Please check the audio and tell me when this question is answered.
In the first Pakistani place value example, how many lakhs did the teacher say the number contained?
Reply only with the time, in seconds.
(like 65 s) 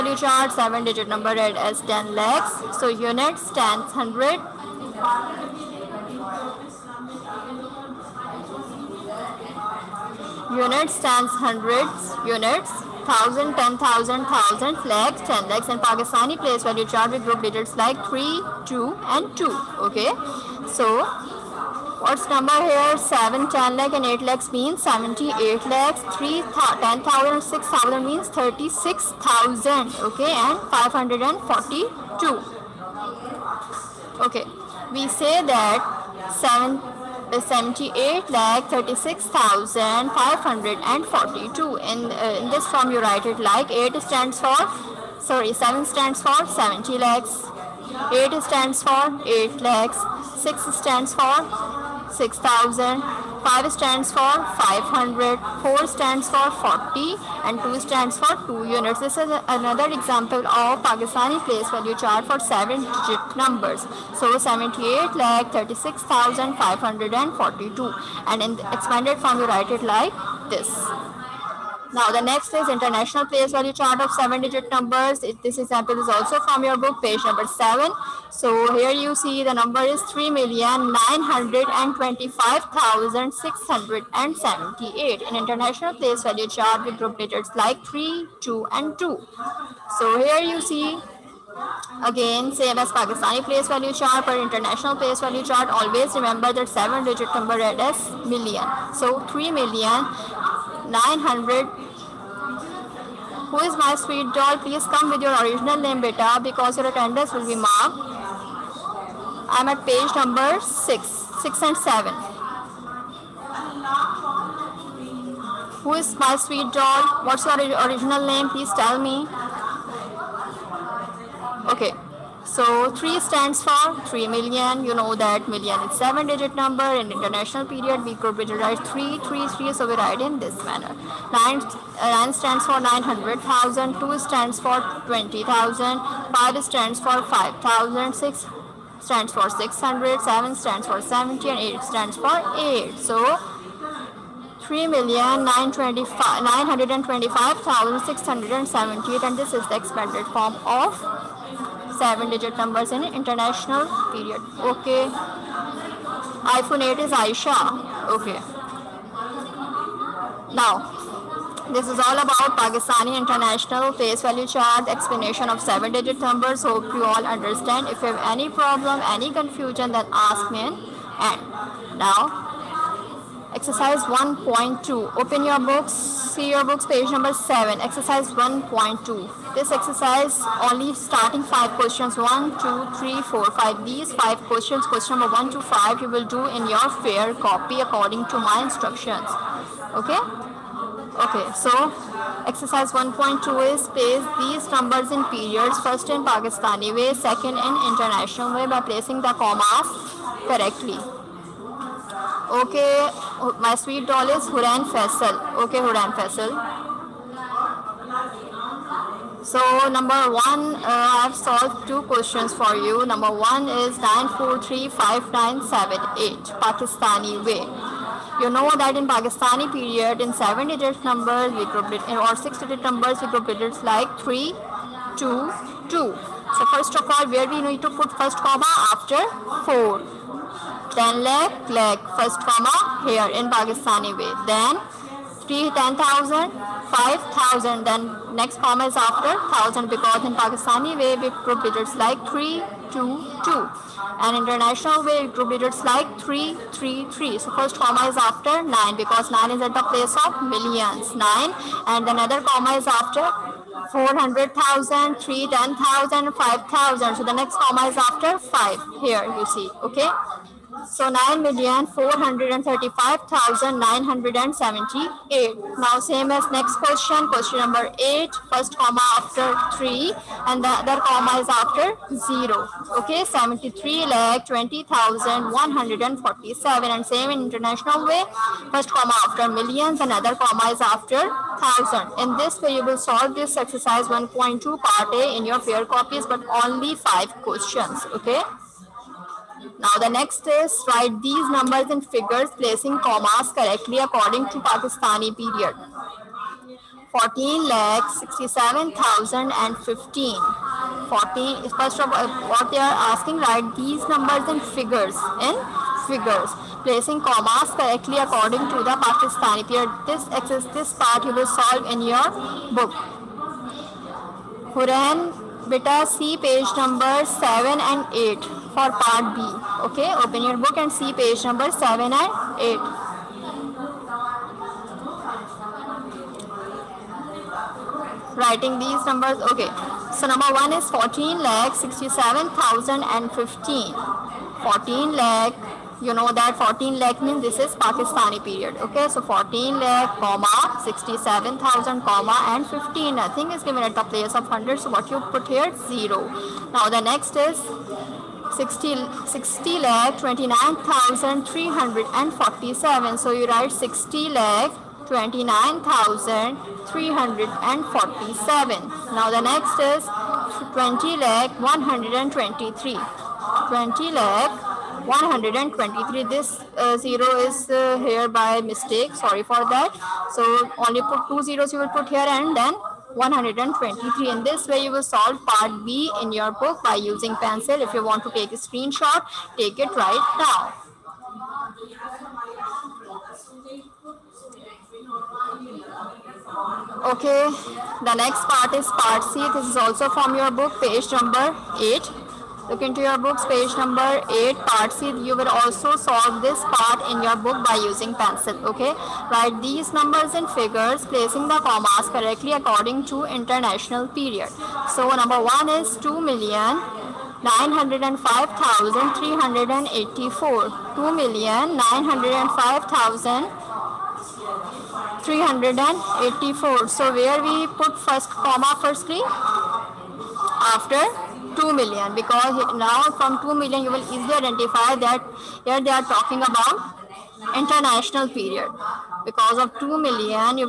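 24 s.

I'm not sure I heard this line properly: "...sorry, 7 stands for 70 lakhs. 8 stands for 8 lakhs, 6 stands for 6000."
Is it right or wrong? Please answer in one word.
right.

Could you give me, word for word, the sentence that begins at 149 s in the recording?
and this is the expanded form of seven digit numbers in international period.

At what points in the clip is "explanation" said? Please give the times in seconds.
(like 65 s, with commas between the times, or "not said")
164 s.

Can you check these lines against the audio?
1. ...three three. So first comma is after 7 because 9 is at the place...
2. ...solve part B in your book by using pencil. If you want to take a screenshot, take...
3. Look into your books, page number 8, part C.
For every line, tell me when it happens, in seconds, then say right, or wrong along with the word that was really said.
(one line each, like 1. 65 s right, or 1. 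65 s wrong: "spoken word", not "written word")
1. 246 s wrong: "9", not "7"
2. 375 s right
3. 392 s right.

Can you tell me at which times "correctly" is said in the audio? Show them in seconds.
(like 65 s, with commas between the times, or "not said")
200 s, 293 s, 307 s, 402 s.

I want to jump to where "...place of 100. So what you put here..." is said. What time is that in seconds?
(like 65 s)
344 s.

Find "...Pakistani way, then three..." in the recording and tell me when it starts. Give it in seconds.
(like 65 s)
233 s.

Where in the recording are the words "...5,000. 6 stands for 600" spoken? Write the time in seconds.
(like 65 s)
137 s.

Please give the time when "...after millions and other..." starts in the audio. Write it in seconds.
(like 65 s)
279 s.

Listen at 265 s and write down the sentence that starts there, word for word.
Now same as next question, question number 8, first comma after 3 and the other comma is after 0.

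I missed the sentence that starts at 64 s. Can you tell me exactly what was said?
So 78 lakh 36,542 and in the expanded form you write it like this.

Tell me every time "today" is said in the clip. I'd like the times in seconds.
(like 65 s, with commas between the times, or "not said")
not said.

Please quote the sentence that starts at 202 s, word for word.
Okay, my sweet doll is Huran Faisal.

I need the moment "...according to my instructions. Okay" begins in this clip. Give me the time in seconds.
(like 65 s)
187 s.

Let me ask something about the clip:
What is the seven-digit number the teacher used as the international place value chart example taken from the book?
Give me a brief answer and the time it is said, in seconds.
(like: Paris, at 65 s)
3,925,678, at 80 s.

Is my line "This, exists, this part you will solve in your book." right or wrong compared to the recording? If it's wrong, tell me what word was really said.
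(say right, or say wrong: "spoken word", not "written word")
right.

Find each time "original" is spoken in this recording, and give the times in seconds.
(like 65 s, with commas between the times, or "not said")
105 s, 117 s.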